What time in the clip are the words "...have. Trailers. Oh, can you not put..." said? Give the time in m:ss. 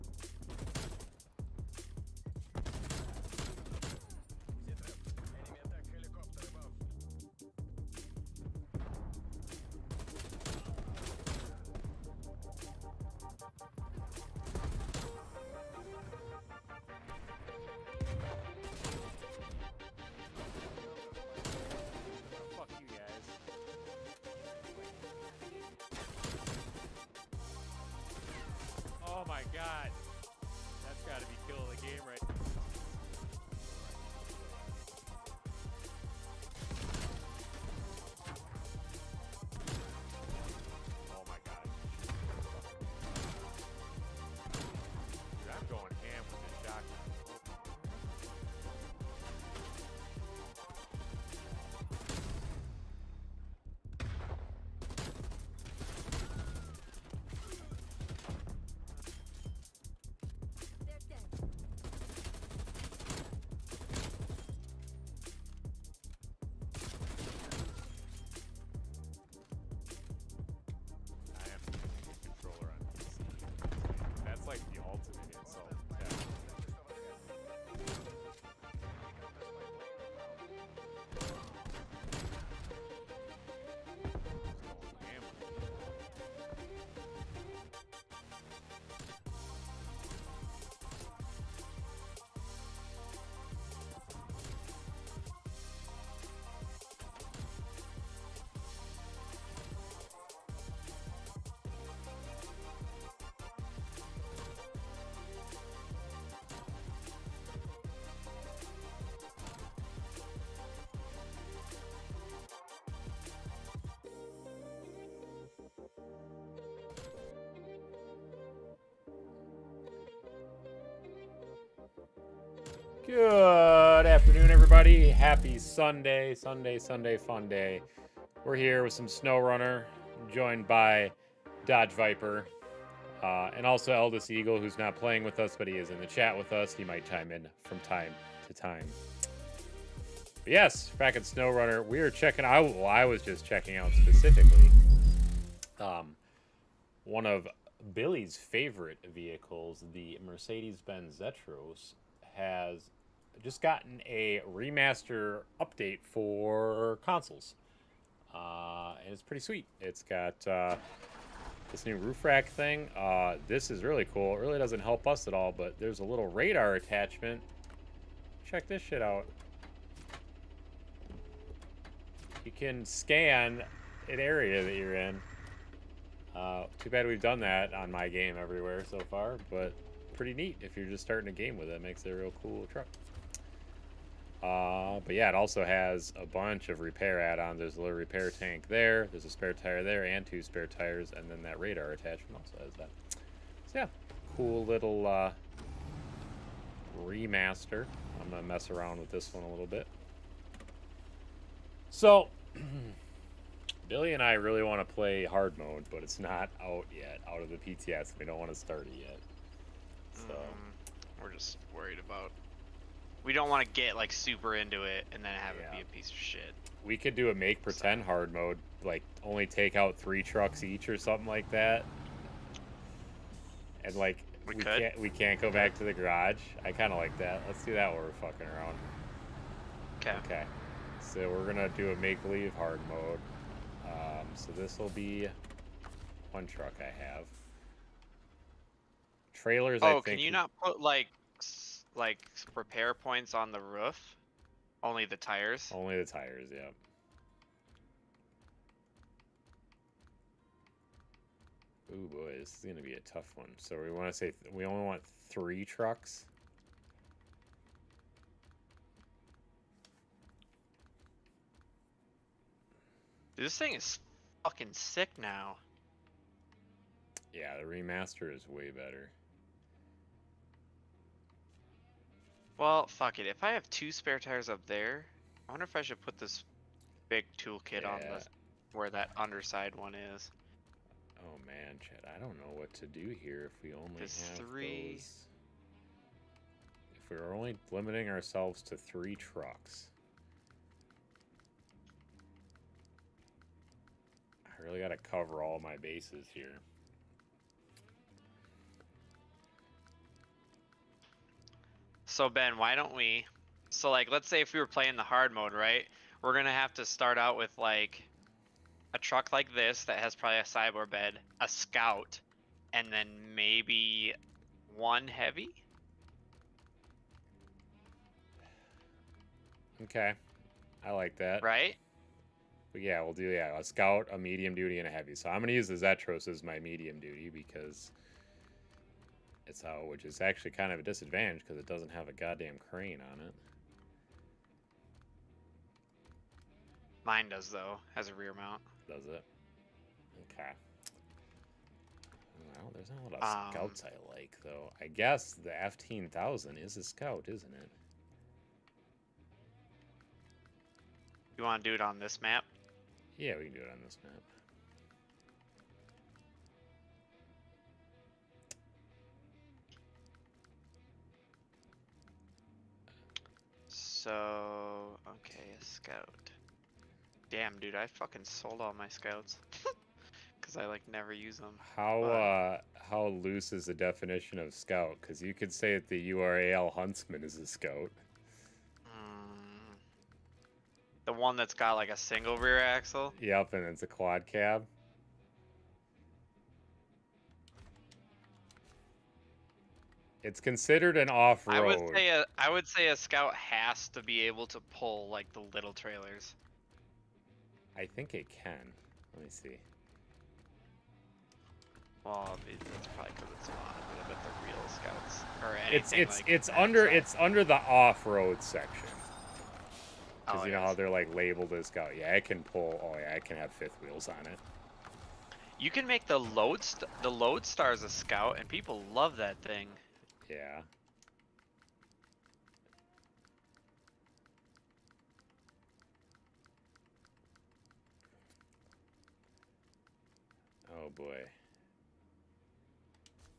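3:57.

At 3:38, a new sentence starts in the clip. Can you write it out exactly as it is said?
hard mode, like only take out three trucks each or something like that.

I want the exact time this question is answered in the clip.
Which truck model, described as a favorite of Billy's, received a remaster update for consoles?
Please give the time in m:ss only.
2:30.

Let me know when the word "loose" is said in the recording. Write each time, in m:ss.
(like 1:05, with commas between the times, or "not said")
6:13.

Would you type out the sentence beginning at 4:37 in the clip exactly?
on the, where that underside one is.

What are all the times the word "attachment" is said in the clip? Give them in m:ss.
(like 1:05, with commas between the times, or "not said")
2:46, 3:11.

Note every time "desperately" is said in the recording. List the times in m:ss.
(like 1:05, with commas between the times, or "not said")
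not said.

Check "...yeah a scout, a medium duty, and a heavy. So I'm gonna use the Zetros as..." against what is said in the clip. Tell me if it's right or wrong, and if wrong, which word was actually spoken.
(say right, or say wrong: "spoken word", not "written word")
right.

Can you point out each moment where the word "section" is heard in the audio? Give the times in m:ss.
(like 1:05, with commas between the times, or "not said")
6:48.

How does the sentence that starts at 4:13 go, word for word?
So we want to say we only want three trucks.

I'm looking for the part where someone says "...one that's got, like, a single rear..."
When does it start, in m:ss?
6:21.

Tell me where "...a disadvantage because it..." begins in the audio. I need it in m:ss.
5:30.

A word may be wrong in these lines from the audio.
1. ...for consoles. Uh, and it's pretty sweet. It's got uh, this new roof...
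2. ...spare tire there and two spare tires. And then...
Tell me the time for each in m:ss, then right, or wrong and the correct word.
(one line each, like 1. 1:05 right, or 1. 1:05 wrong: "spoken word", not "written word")
1. 2:36 right
2. 3:09 right.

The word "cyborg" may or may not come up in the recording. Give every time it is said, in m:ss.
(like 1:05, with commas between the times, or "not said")
5:10.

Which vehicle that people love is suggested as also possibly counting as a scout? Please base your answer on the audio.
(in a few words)
Loadstar.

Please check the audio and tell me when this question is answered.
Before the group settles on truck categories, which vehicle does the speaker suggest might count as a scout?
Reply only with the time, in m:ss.
5:45.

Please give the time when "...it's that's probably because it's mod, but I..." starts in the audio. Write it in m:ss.
6:42.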